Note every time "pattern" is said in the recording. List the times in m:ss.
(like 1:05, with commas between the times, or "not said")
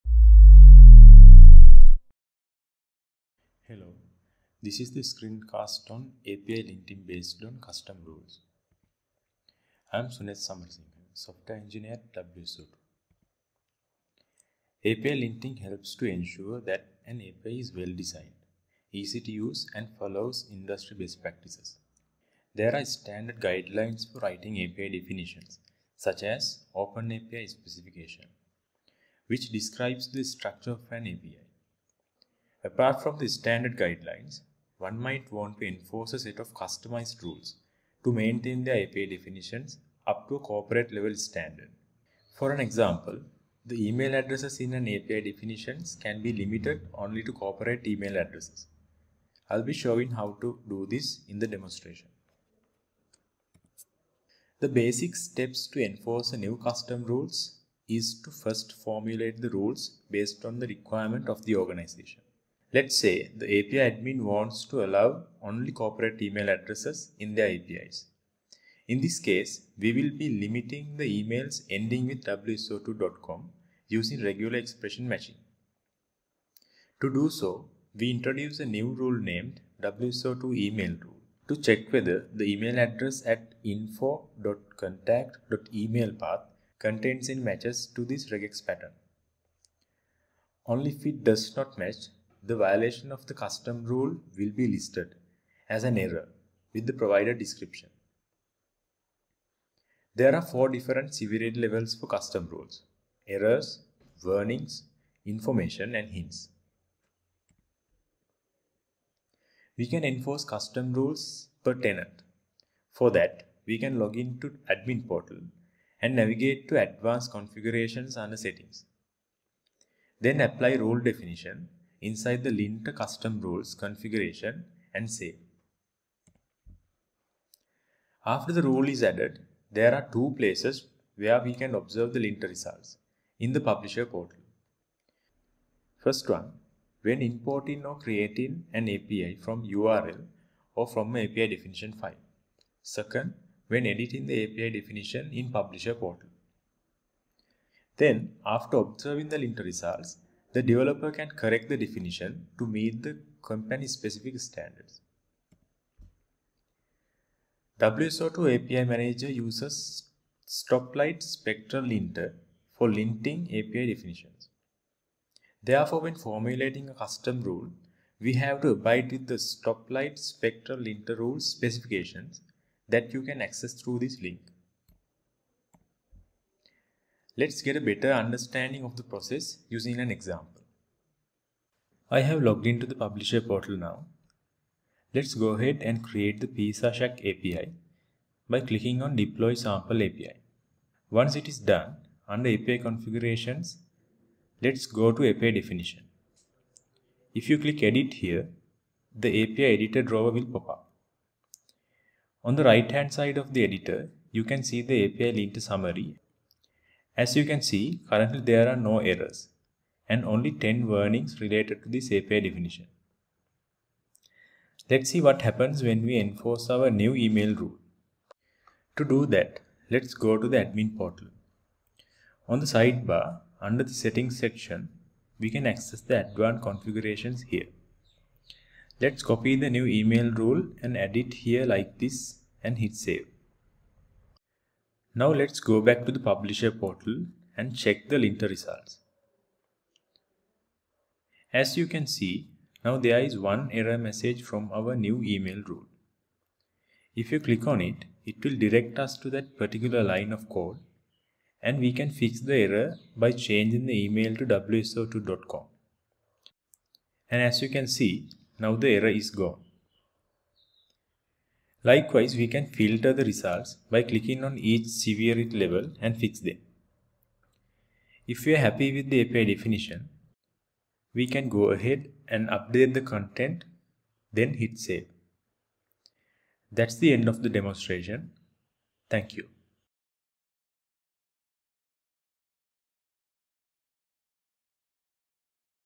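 1:28.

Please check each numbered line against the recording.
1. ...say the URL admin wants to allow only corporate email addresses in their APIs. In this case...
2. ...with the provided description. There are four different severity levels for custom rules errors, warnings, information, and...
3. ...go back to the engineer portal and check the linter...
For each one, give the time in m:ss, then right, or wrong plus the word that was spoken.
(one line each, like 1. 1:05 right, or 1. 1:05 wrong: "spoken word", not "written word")
1. 1:02 wrong: "API", not "URL"
2. 1:36 right
3. 3:55 wrong: "publisher", not "engineer".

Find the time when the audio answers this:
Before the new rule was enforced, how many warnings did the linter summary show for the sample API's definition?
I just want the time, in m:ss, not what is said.
3:30.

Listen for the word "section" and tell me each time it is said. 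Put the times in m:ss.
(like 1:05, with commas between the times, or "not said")
3:44.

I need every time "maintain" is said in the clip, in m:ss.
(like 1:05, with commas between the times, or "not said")
0:38.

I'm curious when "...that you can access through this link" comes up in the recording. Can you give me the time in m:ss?
2:52.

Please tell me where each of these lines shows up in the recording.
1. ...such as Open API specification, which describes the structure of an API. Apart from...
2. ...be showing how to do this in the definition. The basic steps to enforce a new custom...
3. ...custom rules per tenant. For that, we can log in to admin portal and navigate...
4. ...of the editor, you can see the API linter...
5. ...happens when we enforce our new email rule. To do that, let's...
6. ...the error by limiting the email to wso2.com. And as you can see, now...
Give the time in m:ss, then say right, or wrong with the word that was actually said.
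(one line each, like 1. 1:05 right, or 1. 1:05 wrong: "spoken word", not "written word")
1. 0:25 right
2. 0:49 wrong: "demonstration", not "definition"
3. 1:50 right
4. 3:23 right
5. 3:35 right
6. 4:12 wrong: "changing", not "limiting".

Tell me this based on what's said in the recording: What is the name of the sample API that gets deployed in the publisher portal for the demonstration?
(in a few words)
Pizza Shack API.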